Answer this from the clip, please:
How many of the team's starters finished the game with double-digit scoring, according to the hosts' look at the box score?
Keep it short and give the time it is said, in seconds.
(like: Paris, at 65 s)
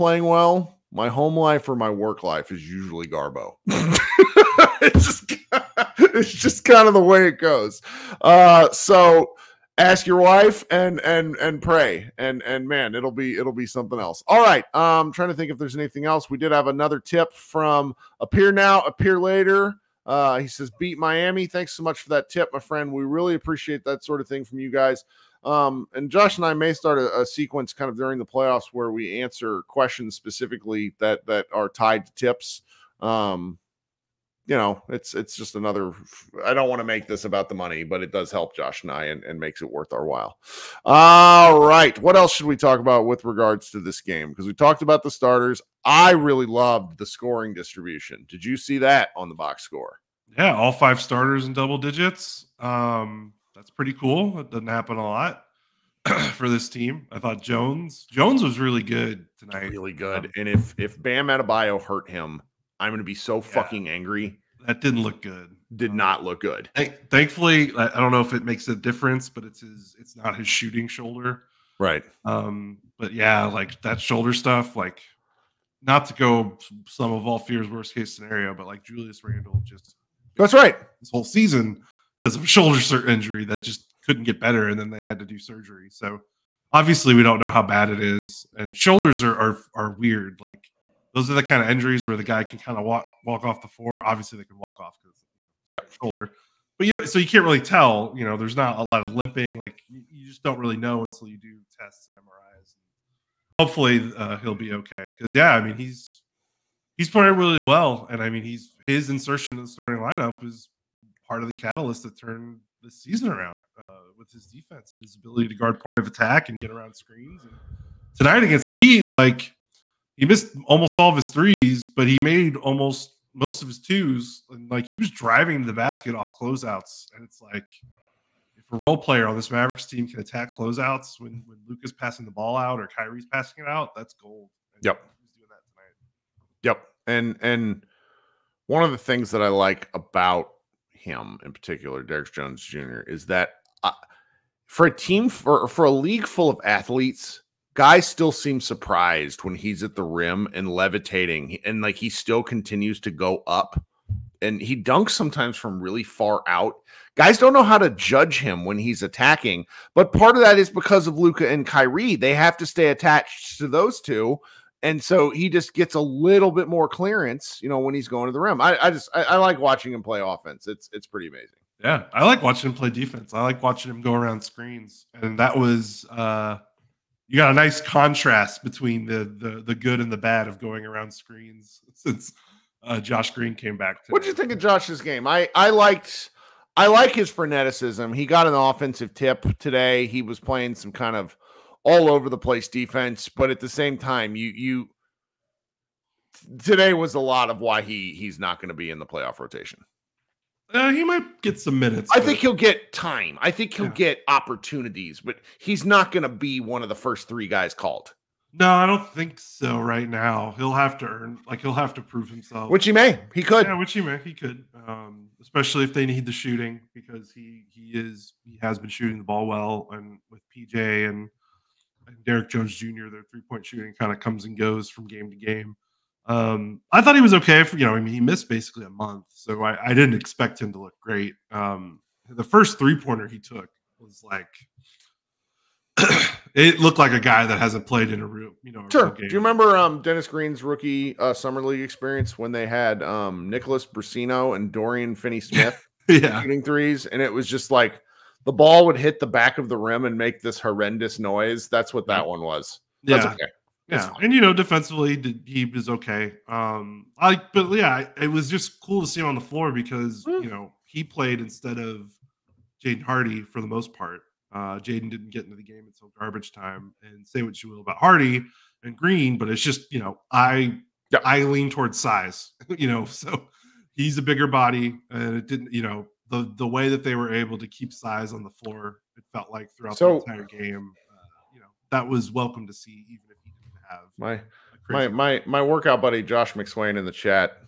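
5, at 50 s.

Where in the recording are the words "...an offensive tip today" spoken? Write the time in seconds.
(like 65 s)
188 s.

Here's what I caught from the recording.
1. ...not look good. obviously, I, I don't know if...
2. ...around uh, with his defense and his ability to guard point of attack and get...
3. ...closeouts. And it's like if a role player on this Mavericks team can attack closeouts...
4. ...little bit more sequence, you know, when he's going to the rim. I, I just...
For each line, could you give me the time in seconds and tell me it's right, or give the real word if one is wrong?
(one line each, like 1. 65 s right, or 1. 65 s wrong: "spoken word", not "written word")
1. 65 s wrong: "thankfully", not "obviously"
2. 113 s right
3. 126 s right
4. 165 s wrong: "clearance", not "sequence".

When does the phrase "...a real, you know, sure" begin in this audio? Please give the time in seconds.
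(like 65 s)
238 s.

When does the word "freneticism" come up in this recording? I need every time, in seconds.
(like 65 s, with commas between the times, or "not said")
187 s.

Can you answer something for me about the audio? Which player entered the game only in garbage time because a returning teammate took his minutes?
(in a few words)
Jaden Hardy.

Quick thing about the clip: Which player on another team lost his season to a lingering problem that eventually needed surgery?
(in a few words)
Julius Randle.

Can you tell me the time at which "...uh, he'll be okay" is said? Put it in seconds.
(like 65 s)
104 s.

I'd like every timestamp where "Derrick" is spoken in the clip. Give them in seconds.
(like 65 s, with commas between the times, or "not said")
142 s, 222 s.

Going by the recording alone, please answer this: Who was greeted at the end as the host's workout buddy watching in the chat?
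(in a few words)
Josh McSwain.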